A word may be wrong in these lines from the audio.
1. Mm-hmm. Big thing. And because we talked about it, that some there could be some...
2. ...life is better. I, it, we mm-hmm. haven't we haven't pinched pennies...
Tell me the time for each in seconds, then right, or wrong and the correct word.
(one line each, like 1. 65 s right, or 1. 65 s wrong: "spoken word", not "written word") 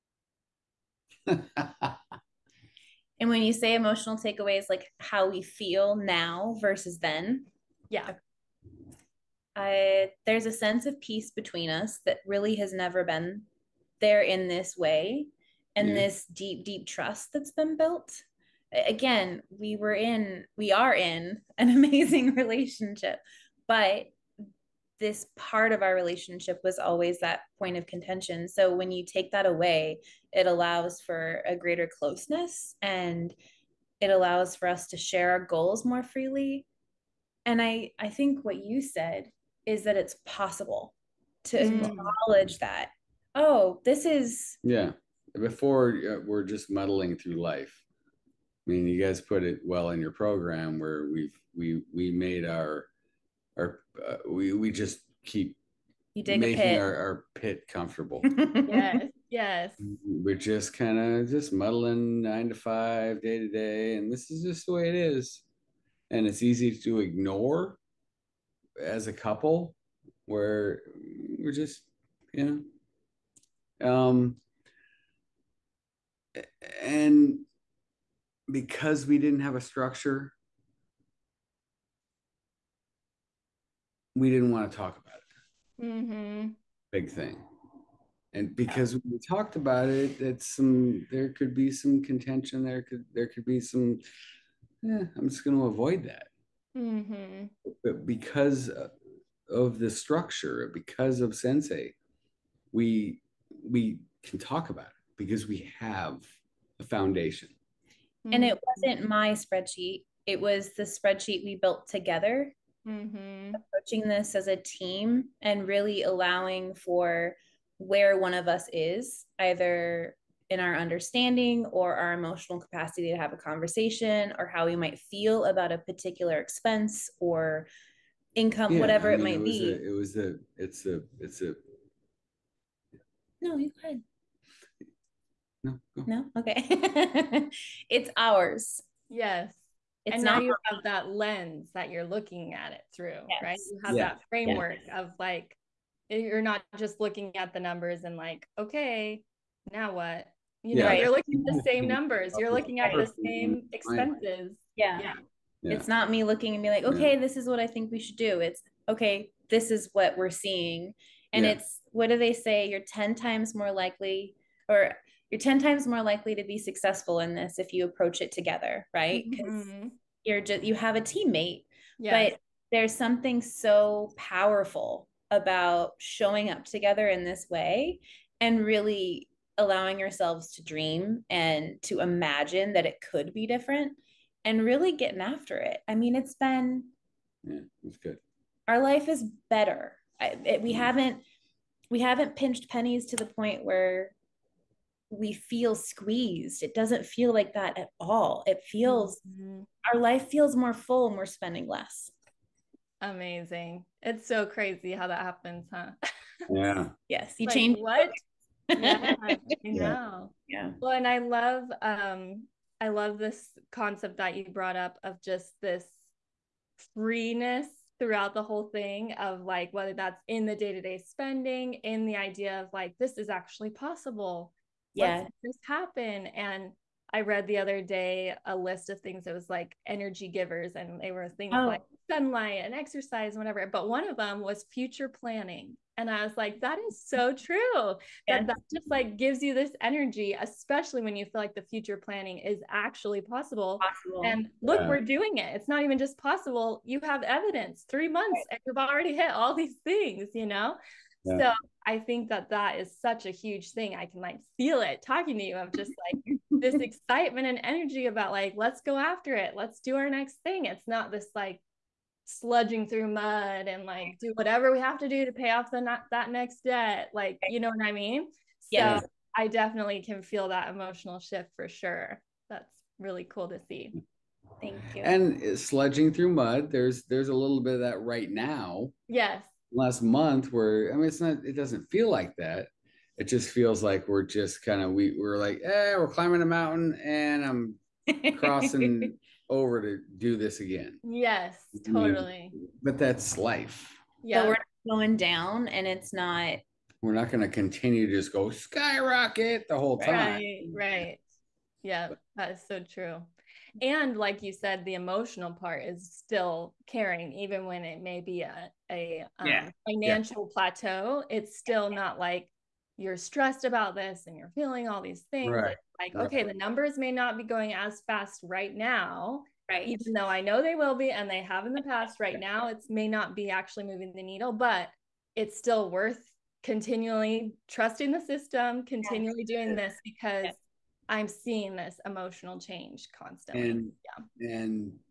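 1. 85 s right
2. 188 s right.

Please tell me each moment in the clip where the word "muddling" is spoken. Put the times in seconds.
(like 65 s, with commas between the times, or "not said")
46 s, 61 s.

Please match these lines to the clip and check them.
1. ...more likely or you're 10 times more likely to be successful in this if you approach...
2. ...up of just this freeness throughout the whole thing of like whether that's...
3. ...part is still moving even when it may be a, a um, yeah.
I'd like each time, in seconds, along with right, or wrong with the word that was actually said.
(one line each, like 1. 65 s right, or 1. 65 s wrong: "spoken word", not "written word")
1. 163 s right
2. 214 s right
3. 305 s wrong: "caring", not "moving".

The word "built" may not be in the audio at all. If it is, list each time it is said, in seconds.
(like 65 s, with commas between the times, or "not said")
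17 s, 111 s.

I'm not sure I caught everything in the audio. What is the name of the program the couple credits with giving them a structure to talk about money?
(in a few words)
Centsei.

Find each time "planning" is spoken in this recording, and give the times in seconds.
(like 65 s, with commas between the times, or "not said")
235 s, 241 s.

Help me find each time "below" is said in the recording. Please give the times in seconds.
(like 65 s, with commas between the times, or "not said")
not said.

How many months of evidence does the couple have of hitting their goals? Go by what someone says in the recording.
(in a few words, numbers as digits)
3 months.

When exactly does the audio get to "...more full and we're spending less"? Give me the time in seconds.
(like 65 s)
200 s.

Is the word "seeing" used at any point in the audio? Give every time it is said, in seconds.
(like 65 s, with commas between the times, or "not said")
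160 s, 331 s.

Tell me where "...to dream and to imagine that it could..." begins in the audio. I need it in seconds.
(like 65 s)
180 s.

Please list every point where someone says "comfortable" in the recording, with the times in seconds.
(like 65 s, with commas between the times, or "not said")
57 s.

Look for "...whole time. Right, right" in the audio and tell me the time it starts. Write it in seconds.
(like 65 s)
299 s.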